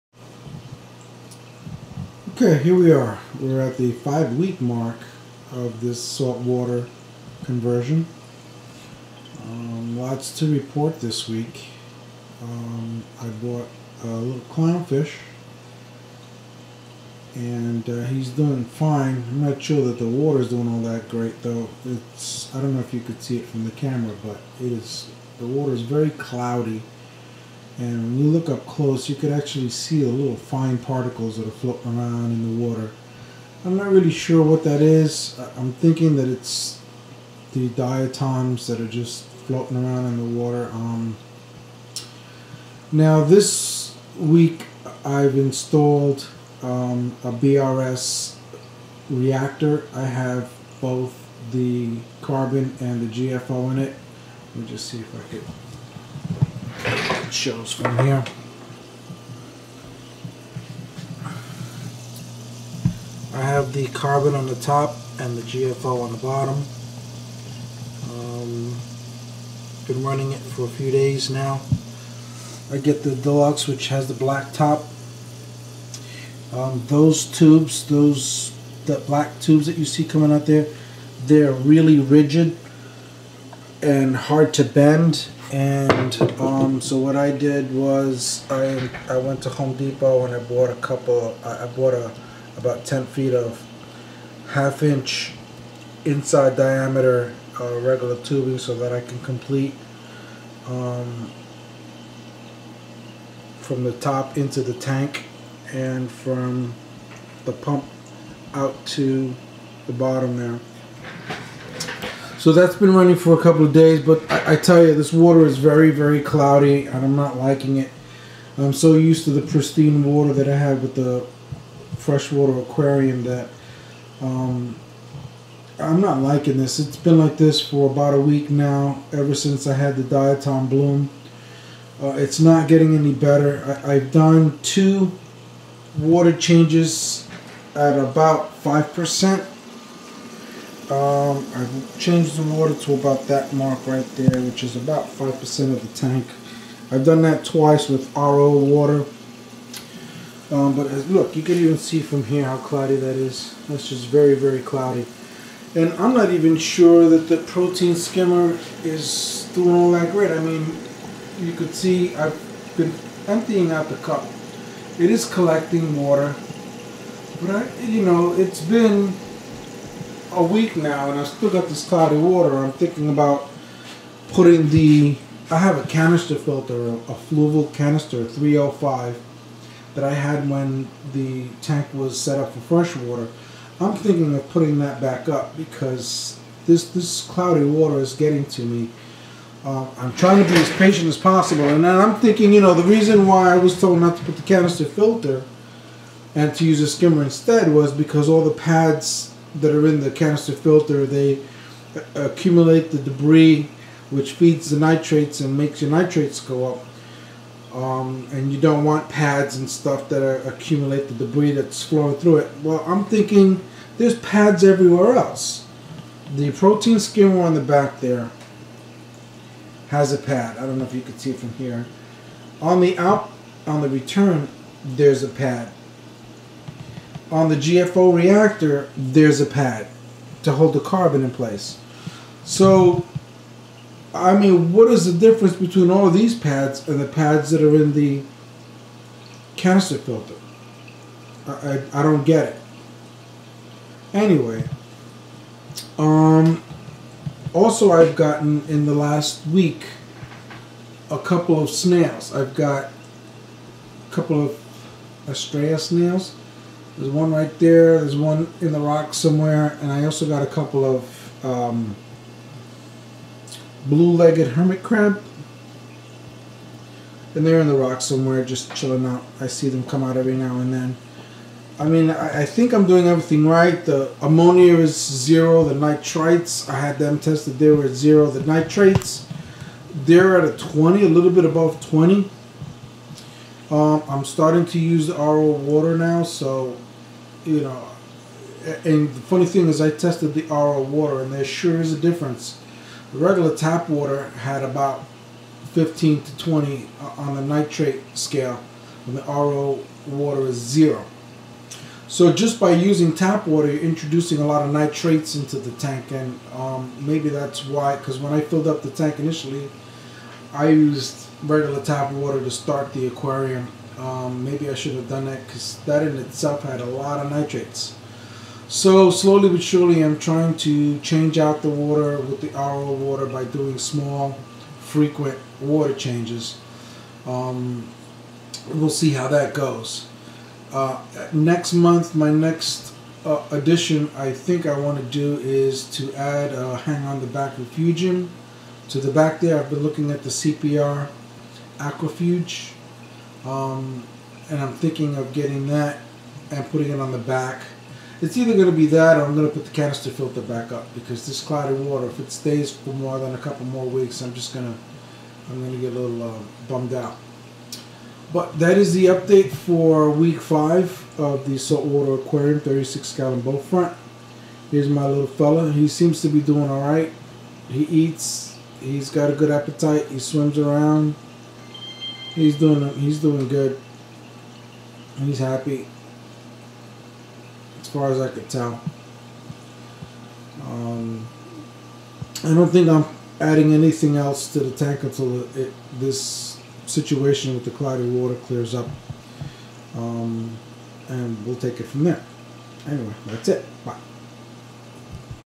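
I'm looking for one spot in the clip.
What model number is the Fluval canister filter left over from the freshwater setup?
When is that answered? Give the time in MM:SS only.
02:58.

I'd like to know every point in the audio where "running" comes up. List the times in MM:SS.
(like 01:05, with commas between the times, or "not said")
01:10, 01:52.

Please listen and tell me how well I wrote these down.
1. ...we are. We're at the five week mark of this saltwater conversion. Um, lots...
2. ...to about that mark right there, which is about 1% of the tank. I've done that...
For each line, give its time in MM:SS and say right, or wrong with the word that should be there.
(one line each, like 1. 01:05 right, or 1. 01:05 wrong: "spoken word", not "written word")
1. 00:02 right
2. 02:22 wrong: "5", not "1".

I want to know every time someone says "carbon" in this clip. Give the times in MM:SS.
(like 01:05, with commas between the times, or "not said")
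00:52, 01:03, 03:50.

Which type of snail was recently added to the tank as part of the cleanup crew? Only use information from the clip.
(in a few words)
Astrea.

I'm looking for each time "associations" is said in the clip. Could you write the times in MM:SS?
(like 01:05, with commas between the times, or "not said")
not said.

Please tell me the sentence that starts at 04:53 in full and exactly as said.
The regular tap water had about 15 to 20 uh, on the nitrate scale and the RO water is zero.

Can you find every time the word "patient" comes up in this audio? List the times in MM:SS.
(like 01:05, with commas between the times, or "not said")
03:10.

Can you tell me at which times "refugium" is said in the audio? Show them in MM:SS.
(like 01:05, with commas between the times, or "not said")
05:37.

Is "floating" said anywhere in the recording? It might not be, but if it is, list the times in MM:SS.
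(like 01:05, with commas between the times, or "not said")
00:31, 00:39.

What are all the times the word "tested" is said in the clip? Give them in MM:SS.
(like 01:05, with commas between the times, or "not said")
04:37, 04:49.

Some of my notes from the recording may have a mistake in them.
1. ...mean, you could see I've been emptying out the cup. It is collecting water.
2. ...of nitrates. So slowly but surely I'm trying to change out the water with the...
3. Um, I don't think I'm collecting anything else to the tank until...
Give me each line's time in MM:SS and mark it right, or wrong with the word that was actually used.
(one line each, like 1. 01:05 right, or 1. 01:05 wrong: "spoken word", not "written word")
1. 02:40 right
2. 05:17 right
3. 06:20 wrong: "adding", not "collecting".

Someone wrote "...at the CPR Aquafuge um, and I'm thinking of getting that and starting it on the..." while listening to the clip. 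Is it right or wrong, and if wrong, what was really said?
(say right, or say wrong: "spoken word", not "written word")
wrong: "putting", not "starting".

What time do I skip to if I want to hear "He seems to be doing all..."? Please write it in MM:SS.
06:05.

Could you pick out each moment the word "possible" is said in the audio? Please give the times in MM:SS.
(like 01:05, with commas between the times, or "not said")
03:11.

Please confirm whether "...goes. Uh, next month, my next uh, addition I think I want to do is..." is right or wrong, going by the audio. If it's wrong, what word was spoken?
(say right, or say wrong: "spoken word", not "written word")
right.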